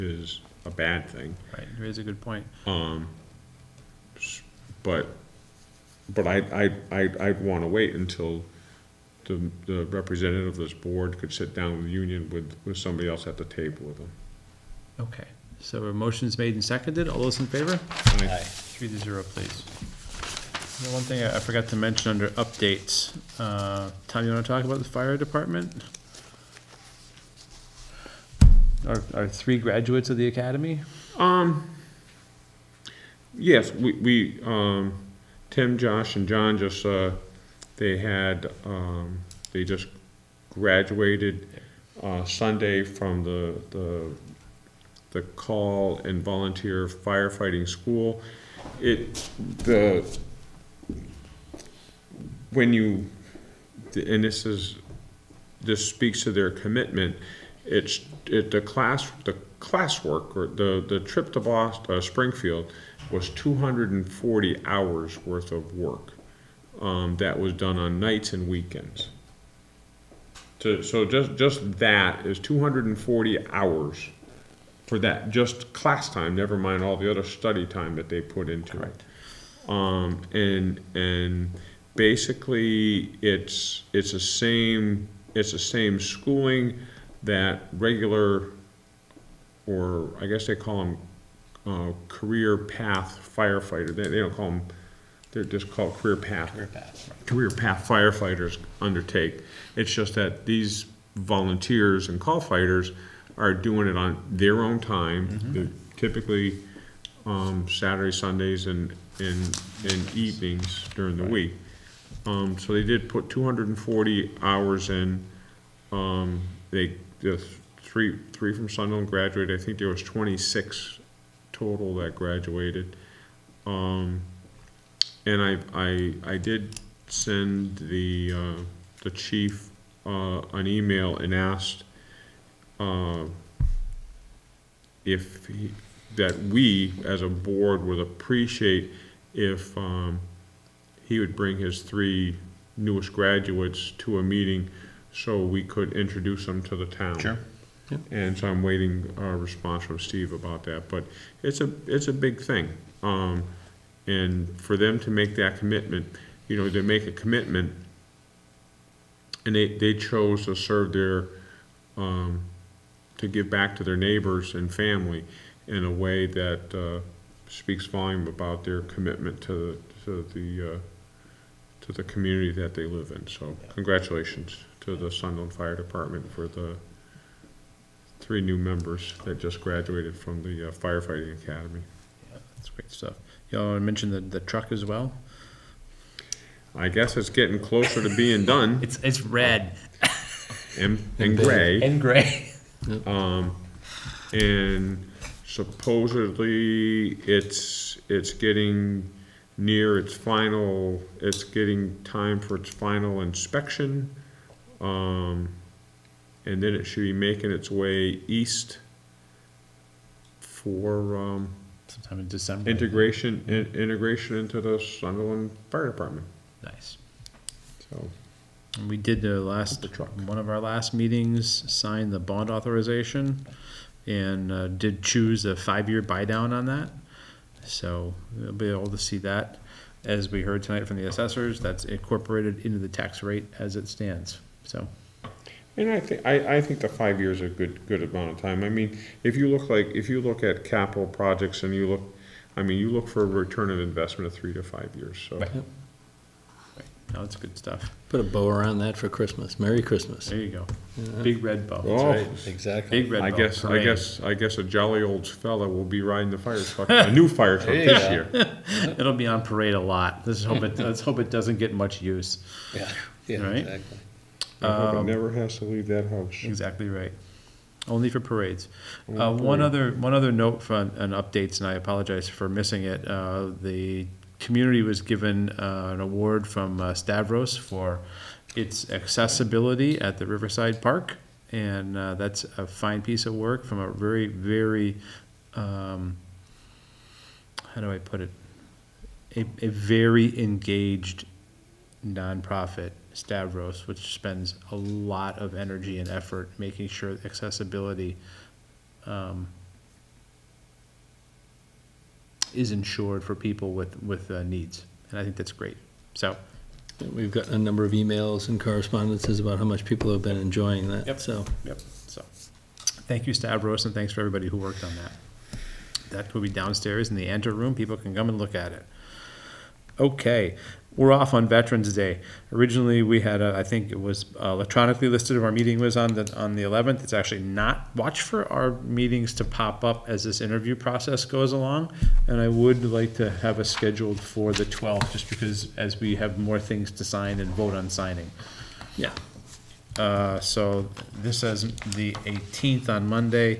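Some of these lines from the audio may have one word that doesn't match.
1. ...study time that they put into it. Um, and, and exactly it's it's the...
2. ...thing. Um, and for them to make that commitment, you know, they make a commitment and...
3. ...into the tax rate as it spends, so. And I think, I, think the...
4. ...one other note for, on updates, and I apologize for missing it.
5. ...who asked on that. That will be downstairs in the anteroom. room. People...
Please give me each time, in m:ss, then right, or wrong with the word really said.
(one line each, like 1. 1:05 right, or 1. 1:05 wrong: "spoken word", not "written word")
1. 1:17 wrong: "basically", not "exactly"
2. 2:32 right
3. 3:52 wrong: "stands", not "spends"
4. 4:29 right
5. 5:14 wrong: "worked", not "asked".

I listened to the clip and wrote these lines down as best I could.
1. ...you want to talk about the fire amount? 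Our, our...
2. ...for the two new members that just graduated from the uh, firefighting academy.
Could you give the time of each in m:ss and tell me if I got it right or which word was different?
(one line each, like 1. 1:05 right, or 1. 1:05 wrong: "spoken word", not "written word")
1. 0:24 wrong: "department", not "amount"
2. 2:56 wrong: "three", not "two".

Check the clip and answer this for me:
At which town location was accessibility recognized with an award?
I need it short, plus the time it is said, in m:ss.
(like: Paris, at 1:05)
Riverside Park, at 4:40.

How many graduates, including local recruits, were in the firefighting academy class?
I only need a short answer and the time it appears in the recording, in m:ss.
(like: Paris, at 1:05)
26, at 2:00.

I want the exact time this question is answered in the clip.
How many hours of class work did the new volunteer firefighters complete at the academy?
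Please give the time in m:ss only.
1:03.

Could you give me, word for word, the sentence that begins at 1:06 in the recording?
Um, that was done on nights and weekends.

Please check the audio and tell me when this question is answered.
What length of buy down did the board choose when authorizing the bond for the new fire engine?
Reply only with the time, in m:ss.
3:45.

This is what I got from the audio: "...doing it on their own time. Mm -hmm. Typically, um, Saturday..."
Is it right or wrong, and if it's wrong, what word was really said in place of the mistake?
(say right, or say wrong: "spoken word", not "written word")
right.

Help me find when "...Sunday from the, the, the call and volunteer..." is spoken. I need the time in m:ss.
0:42.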